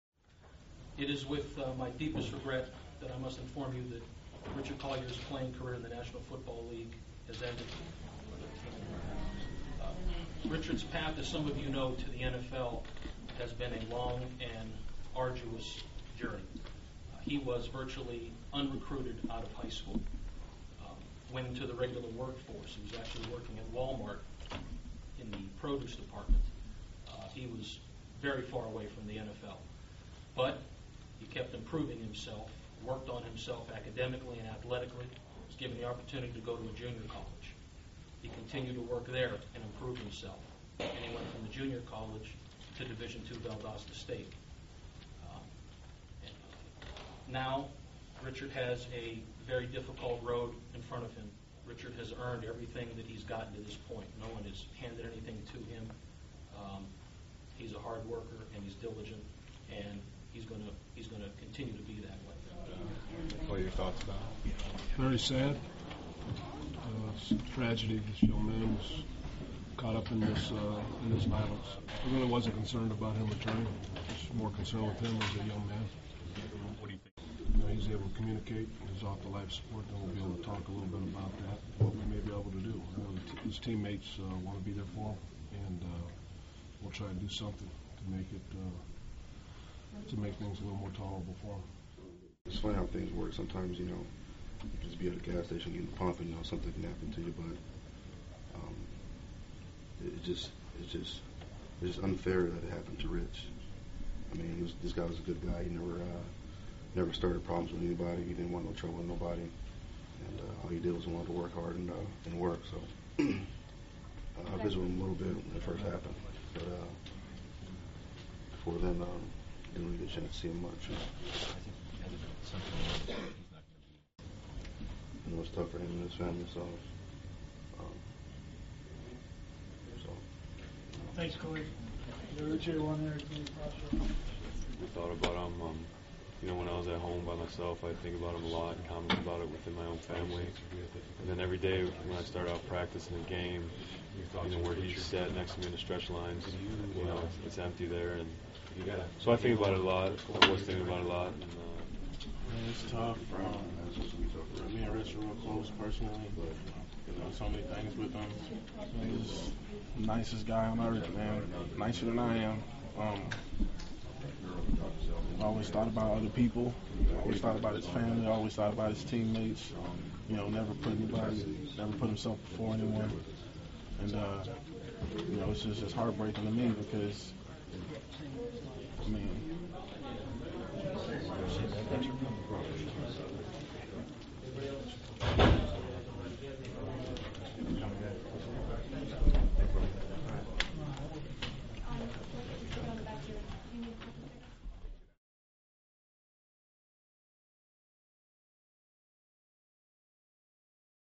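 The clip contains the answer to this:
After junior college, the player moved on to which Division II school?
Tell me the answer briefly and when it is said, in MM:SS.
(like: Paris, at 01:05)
Valdosta State, at 00:43.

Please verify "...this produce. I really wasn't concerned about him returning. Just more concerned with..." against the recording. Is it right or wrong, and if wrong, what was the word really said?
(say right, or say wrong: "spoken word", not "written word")
wrong: "violence", not "produce".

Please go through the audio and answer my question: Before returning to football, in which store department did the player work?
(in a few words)
Produce department.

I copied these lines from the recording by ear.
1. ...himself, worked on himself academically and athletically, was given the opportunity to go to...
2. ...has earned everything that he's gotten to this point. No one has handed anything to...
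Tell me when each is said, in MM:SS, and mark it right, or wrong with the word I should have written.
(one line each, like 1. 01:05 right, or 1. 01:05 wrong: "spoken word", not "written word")
1. 00:31 right
2. 00:51 right.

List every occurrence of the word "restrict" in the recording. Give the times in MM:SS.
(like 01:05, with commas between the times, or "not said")
not said.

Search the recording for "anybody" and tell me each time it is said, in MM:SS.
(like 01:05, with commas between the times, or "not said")
01:47, 02:50.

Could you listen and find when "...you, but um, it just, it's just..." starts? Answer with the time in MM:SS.
01:37.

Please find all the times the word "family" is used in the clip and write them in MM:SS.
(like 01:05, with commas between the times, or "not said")
02:06, 02:19, 02:47.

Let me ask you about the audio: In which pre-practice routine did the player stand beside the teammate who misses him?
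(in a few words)
Stretch lines.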